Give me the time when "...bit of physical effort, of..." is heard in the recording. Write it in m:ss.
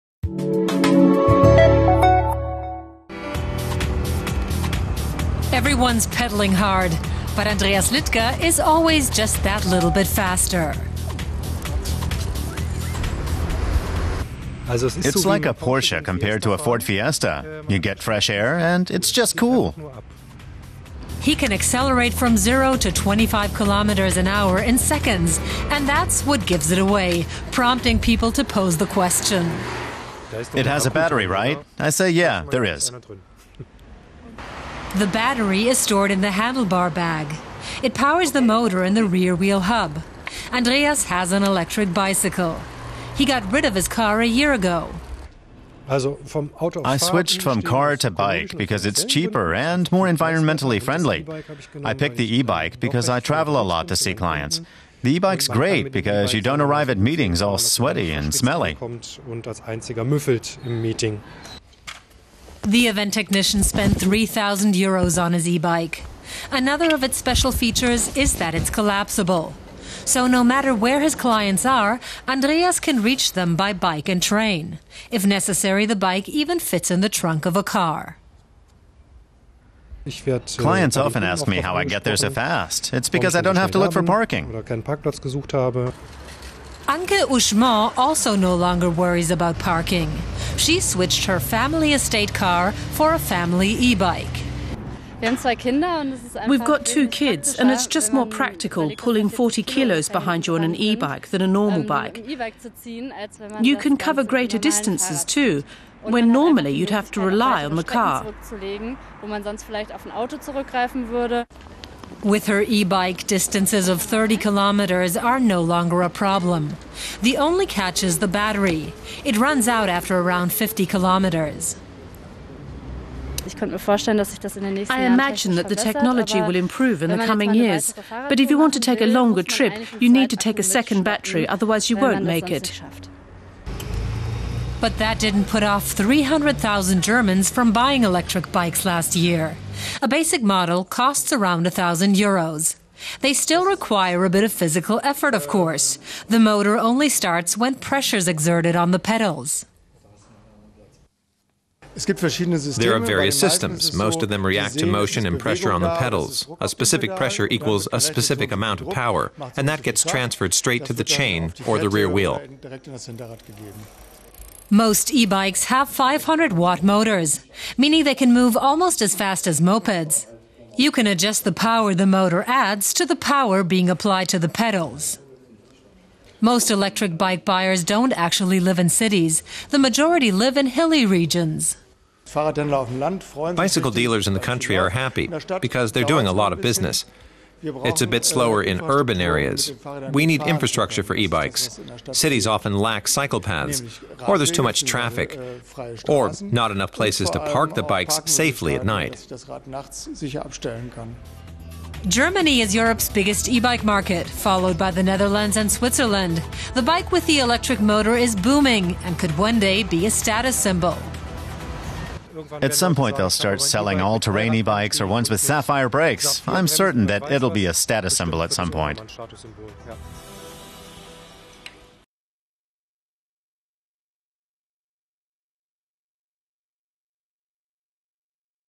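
2:24.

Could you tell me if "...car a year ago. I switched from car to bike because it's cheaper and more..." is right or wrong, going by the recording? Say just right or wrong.
right.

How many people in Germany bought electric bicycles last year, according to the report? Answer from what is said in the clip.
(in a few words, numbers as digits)
300,000.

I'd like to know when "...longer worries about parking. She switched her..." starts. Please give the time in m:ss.
1:28.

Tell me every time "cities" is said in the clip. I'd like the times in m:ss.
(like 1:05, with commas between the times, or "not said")
2:58, 3:12.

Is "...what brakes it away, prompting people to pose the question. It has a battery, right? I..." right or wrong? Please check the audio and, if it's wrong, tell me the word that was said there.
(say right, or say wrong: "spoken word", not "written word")
wrong: "gives", not "brakes".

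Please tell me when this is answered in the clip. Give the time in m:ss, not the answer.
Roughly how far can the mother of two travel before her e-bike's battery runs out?
2:00.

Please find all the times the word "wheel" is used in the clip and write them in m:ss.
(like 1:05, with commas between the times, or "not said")
0:39, 2:42.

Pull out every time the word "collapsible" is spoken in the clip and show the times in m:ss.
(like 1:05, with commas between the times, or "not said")
1:08.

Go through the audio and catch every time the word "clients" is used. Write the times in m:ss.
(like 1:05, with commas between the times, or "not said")
0:54, 1:11, 1:20.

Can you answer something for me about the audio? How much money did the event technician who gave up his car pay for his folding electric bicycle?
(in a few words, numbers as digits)
3,000 euros.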